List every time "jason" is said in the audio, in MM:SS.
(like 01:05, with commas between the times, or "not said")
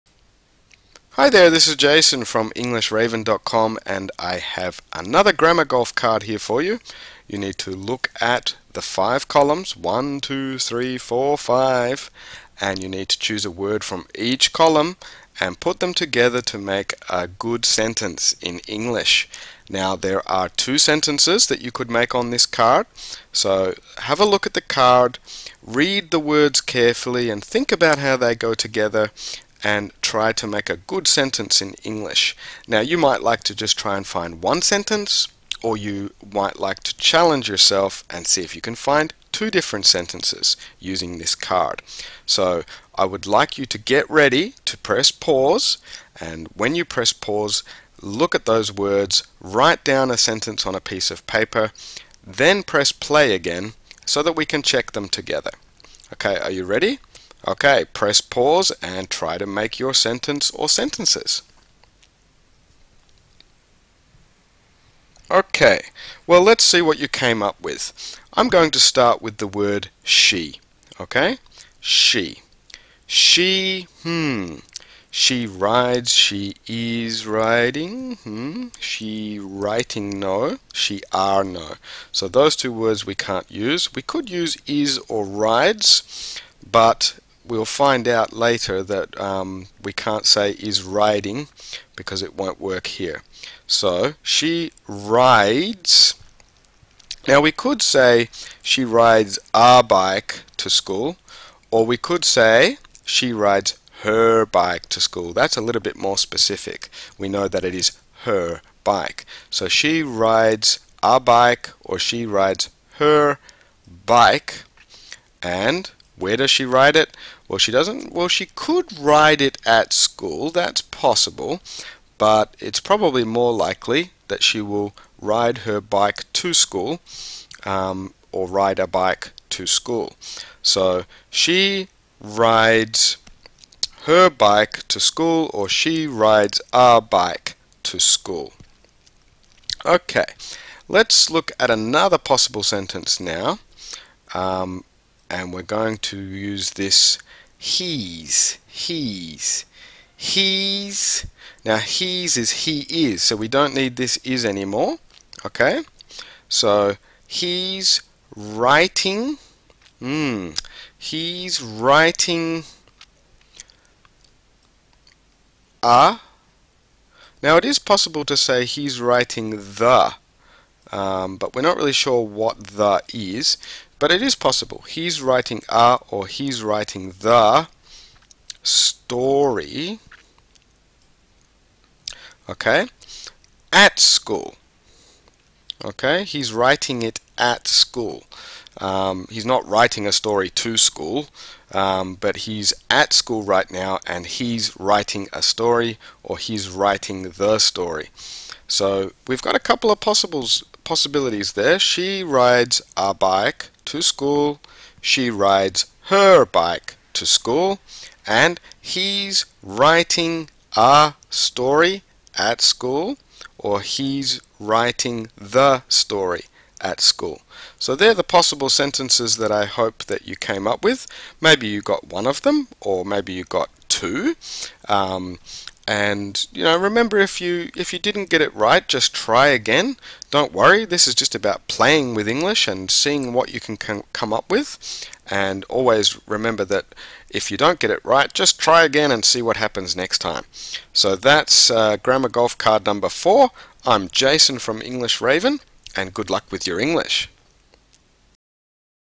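00:01, 04:04.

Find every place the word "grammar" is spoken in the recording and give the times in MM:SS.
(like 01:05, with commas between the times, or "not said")
00:05, 04:01.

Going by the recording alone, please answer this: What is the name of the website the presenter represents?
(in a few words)
EnglishRaven.com.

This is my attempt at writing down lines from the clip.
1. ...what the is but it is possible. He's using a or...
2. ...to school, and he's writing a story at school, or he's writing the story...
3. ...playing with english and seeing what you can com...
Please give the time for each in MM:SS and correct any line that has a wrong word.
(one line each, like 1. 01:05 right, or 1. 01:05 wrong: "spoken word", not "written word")
1. 02:52 wrong: "writing", not "using"
2. 03:27 right
3. 03:51 right.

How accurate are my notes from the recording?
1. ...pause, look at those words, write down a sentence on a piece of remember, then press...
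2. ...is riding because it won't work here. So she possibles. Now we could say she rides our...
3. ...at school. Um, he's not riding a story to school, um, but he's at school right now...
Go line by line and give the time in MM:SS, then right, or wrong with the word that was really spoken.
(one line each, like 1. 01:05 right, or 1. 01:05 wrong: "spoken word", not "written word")
1. 00:47 wrong: "paper", not "remember"
2. 01:30 wrong: "rides", not "possibles"
3. 03:07 wrong: "writing", not "riding".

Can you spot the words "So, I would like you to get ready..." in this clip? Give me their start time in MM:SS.
00:42.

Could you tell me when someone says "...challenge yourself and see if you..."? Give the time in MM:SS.
00:36.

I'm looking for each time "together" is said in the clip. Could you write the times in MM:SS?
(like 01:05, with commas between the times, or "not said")
00:15, 00:28, 00:55.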